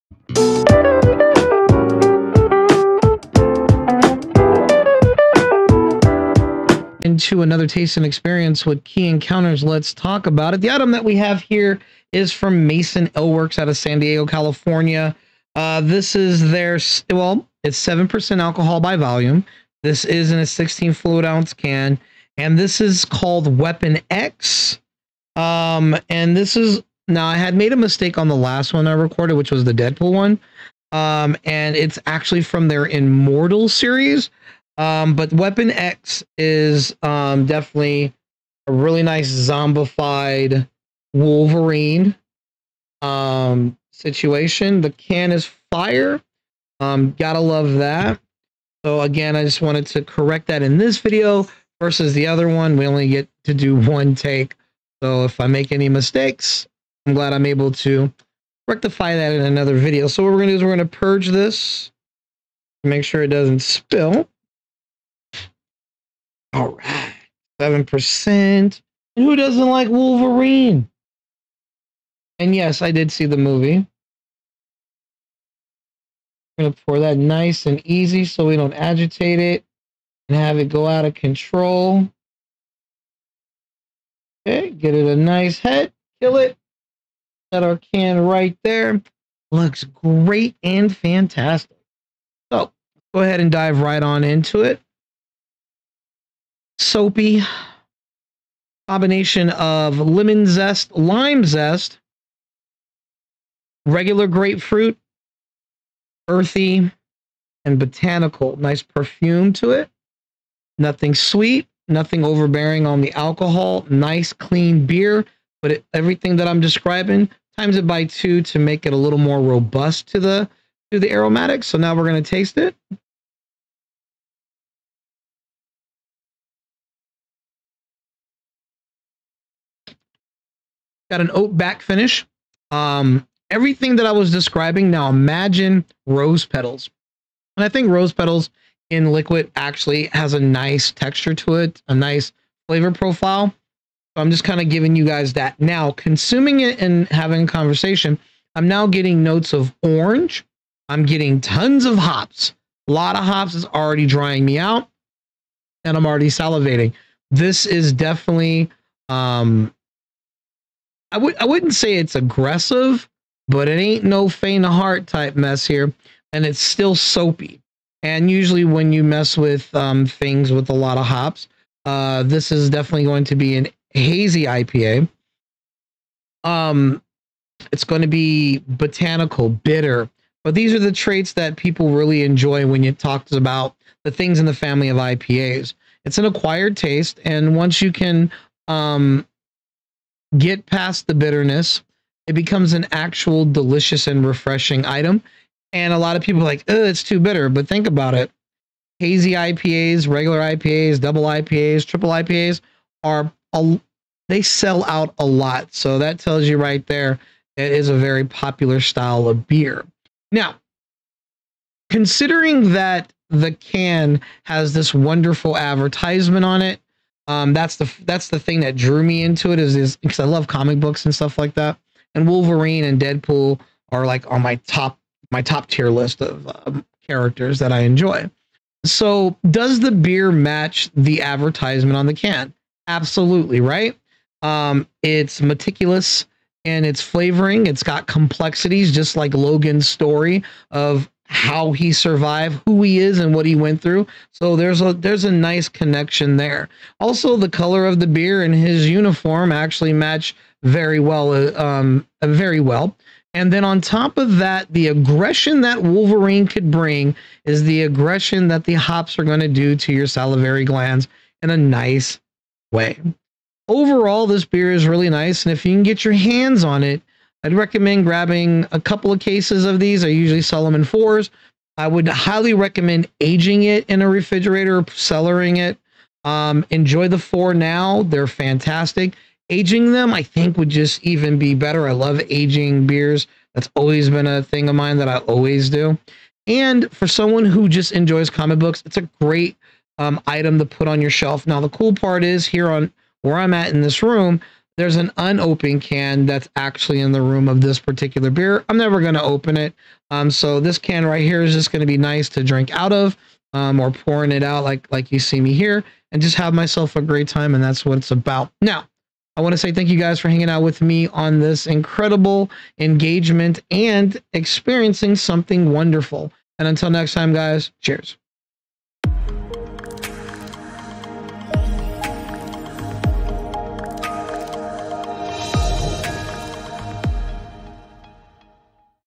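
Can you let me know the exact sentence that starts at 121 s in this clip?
So now we're going to taste it.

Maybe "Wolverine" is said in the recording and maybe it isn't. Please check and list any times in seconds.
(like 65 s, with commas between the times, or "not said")
41 s, 69 s, 222 s, 255 s.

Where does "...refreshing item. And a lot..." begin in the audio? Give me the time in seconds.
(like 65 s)
194 s.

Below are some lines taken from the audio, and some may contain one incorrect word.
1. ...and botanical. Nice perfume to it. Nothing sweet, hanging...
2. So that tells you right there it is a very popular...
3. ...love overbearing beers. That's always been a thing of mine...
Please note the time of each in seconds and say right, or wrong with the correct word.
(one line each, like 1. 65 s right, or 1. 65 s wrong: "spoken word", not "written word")
1. 107 s wrong: "nothing", not "hanging"
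2. 205 s right
3. 281 s wrong: "aging", not "overbearing".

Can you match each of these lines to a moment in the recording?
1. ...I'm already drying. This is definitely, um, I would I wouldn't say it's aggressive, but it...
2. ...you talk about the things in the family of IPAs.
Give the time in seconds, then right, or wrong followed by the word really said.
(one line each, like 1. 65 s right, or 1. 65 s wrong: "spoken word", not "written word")
1. 155 s wrong: "salivating", not "drying"
2. 182 s right.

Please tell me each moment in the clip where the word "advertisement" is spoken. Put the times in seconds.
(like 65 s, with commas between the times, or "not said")
215 s, 231 s.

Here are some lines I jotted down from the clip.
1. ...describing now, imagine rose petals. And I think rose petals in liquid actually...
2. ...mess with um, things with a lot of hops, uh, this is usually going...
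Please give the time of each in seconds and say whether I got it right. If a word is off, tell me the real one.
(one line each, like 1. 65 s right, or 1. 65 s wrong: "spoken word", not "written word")
1. 134 s right
2. 169 s wrong: "definitely", not "usually".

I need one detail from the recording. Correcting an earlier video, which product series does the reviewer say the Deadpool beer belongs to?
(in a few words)
Immortal series.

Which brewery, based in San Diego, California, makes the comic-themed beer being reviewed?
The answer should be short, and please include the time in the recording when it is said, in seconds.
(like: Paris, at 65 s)
Mason Ale Works, at 12 s.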